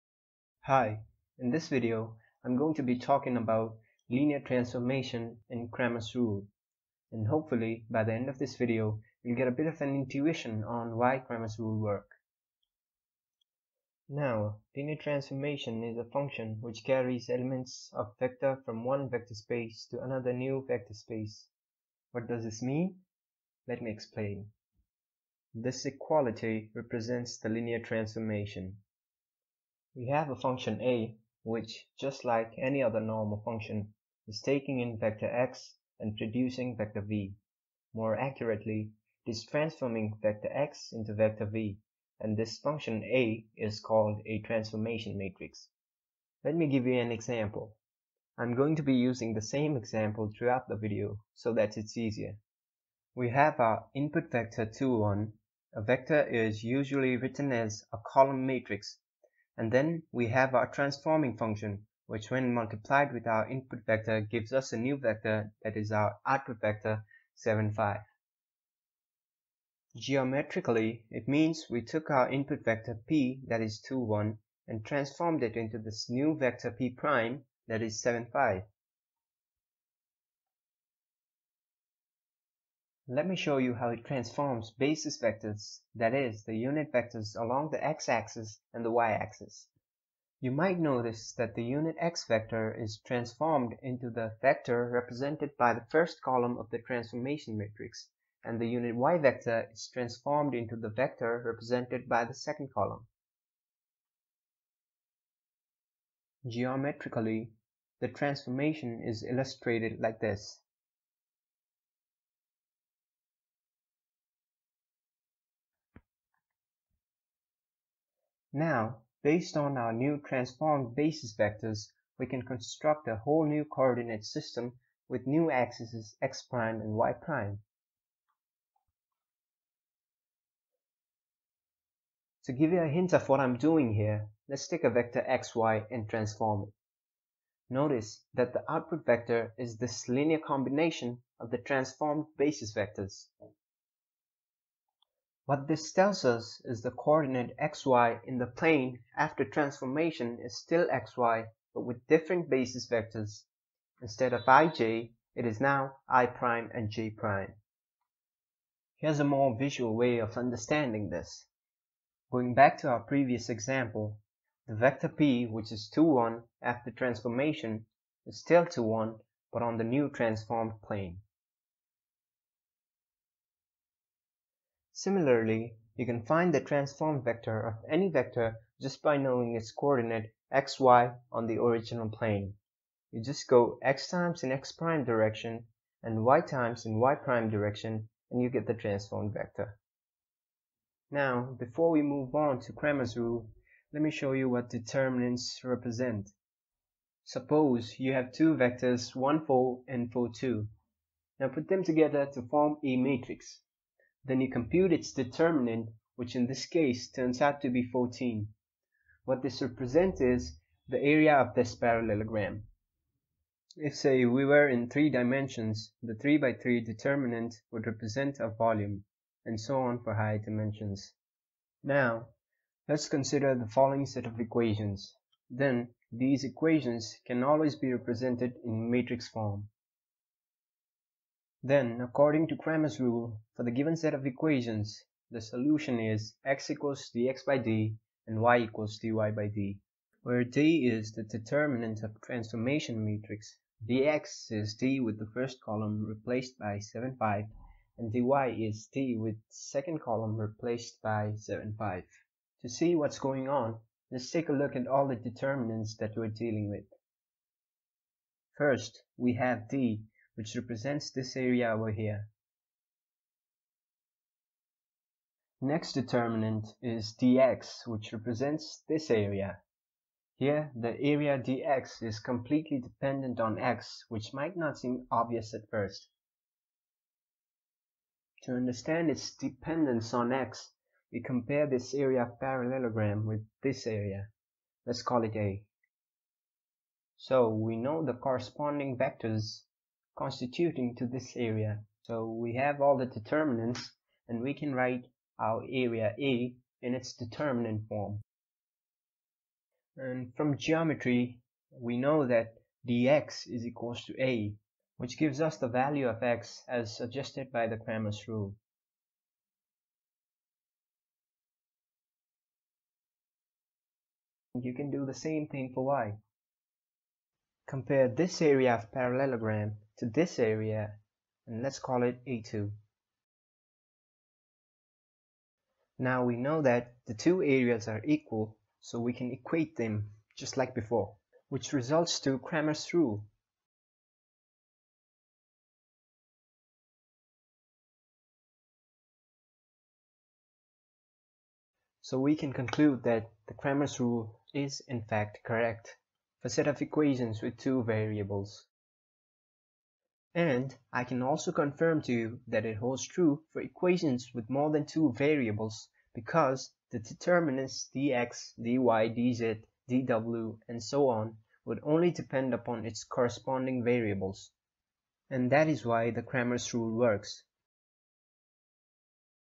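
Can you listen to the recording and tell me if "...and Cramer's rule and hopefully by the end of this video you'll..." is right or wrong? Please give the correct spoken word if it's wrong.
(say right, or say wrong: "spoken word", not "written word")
right.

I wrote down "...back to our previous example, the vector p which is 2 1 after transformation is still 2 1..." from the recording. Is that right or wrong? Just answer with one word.
right.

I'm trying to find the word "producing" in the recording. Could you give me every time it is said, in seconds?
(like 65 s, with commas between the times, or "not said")
36 s.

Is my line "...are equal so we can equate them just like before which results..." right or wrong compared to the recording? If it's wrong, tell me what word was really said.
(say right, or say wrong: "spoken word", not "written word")
right.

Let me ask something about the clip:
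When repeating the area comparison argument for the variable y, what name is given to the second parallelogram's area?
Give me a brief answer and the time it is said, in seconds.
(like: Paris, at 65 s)
A2, at 322 s.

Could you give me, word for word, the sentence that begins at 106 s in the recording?
Geometrically, the transformation is illustrated like this.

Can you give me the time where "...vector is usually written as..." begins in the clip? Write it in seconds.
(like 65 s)
55 s.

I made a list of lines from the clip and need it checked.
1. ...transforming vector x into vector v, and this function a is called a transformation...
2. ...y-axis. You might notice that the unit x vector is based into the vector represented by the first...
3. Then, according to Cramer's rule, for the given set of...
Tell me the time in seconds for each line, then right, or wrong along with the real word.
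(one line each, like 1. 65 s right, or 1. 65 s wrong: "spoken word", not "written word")
1. 39 s right
2. 88 s wrong: "transformed", not "based"
3. 231 s right.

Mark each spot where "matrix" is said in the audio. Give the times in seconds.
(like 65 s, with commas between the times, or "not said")
45 s, 58 s, 97 s, 202 s, 228 s, 243 s.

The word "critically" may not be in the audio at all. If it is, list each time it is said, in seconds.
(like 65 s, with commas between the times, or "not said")
not said.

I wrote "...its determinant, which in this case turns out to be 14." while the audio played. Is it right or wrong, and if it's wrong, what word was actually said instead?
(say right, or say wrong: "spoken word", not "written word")
right.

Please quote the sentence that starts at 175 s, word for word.
Similarly, you can find the transformed vector of any vector just by knowing its coordinate xy on the original plane.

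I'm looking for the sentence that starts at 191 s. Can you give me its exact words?
Now, before we move on to Cramer's rule, let me show you what determinants represent.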